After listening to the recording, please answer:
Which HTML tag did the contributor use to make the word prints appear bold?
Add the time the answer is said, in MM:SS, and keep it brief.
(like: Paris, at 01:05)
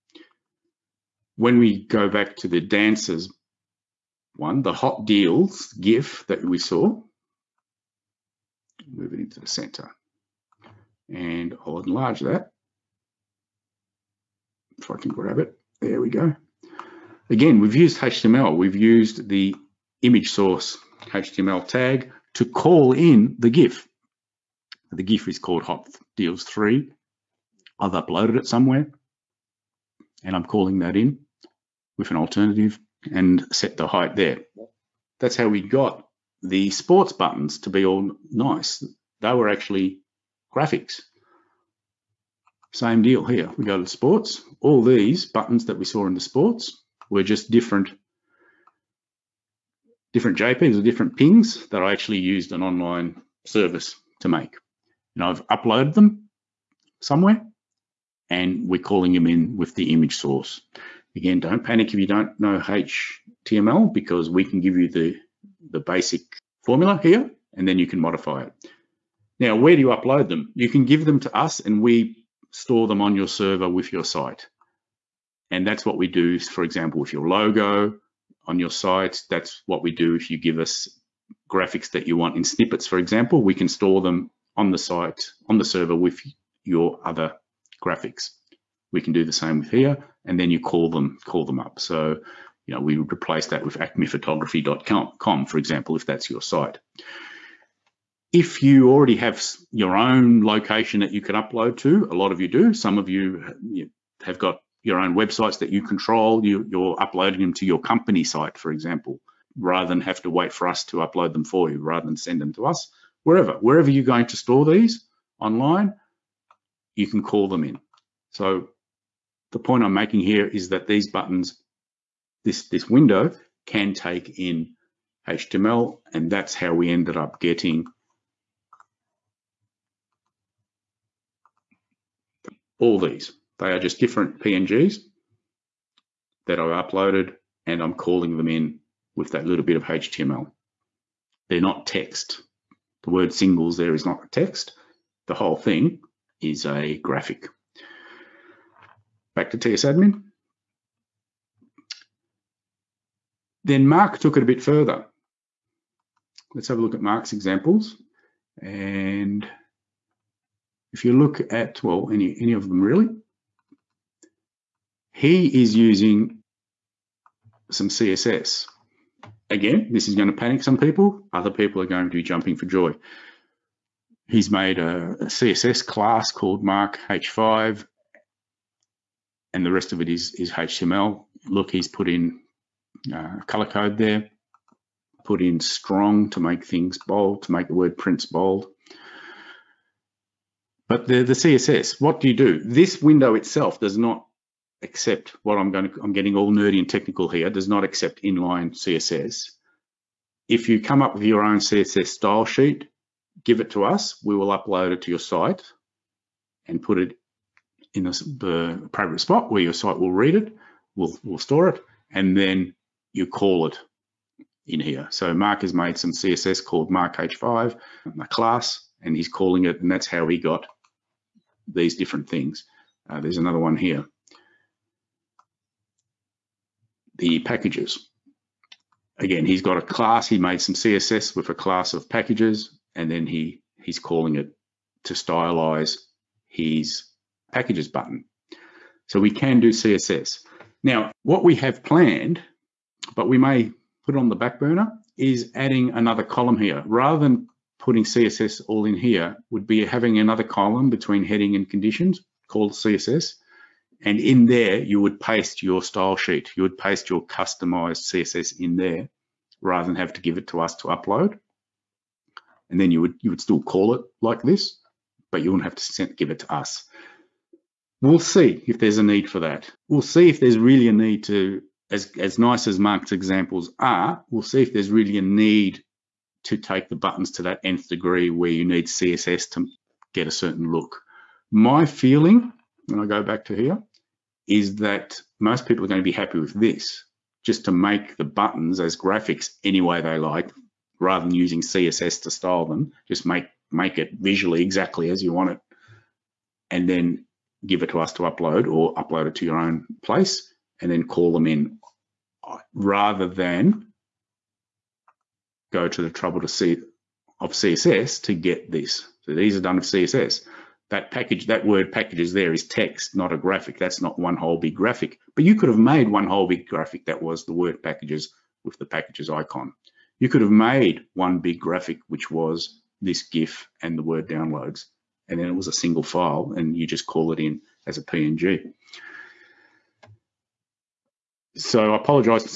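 strong, at 03:05.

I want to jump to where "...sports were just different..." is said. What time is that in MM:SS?
00:46.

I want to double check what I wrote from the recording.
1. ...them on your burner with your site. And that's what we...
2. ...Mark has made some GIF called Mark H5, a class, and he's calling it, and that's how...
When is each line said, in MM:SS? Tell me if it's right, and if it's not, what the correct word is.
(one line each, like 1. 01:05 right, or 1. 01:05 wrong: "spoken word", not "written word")
1. 01:12 wrong: "server", not "burner"
2. 03:35 wrong: "CSS", not "GIF".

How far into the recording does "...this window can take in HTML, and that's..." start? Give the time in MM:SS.
02:02.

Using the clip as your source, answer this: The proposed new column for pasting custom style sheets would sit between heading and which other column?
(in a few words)
conditions.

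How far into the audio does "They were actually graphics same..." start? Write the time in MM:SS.
00:39.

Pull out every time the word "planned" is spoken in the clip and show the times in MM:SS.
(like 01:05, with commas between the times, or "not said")
04:01.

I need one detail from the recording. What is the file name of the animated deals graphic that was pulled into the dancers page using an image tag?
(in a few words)
Hot Deals 3.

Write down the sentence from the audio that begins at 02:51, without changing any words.
Other people are going to be jumping for joy.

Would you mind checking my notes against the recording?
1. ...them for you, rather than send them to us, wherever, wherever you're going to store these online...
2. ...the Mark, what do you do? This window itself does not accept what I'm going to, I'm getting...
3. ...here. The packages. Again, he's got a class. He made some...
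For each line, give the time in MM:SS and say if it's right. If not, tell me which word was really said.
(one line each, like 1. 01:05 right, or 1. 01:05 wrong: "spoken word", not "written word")
1. 01:51 right
2. 03:11 wrong: "CSS", not "Mark"
3. 03:43 right.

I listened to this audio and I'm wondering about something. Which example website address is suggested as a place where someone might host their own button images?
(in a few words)
acmephotography.com.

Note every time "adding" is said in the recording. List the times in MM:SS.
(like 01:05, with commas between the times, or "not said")
04:05.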